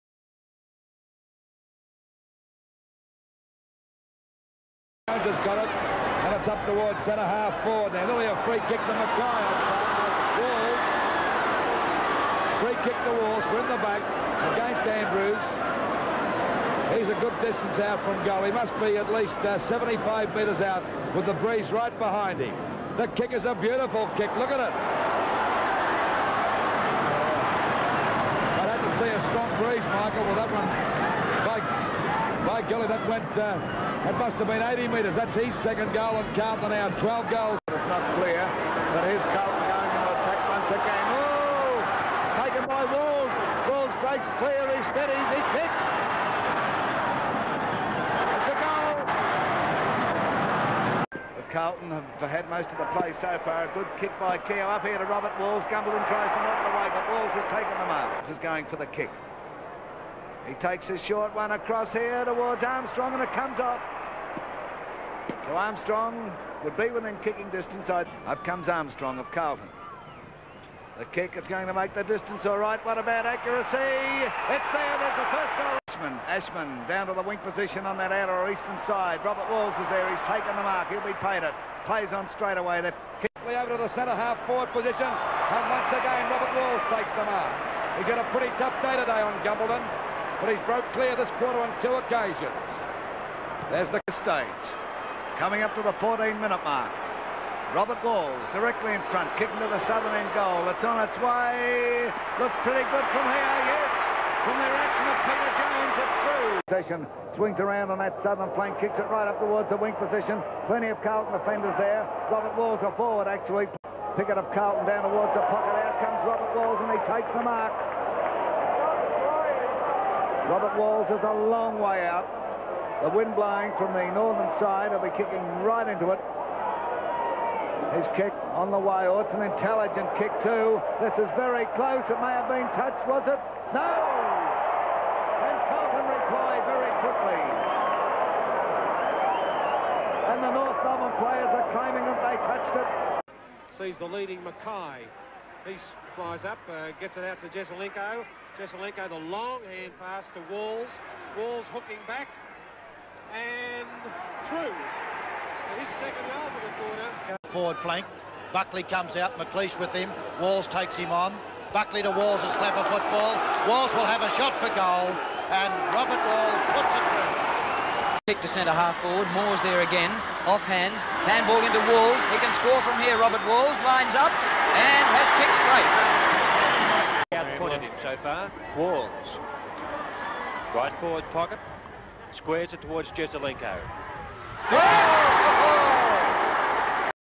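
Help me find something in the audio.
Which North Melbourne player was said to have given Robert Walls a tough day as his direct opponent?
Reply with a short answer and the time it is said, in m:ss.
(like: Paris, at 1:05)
Gumbleton, at 1:29.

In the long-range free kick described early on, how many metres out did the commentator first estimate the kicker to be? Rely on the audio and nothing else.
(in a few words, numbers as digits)
75.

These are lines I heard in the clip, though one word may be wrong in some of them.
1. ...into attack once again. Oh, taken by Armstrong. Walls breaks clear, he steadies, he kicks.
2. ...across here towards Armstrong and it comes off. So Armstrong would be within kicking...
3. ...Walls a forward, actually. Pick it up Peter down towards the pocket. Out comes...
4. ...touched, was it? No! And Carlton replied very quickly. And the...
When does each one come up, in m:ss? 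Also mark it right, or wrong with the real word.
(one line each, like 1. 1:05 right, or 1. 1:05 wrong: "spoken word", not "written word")
1. 0:39 wrong: "Walls", not "Armstrong"
2. 1:01 right
3. 1:52 wrong: "Carlton", not "Peter"
4. 2:12 right.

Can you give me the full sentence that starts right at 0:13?
We're in the back against Andrews.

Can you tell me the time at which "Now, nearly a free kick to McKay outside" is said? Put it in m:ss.
0:07.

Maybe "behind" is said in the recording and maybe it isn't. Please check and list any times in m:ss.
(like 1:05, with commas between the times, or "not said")
0:21.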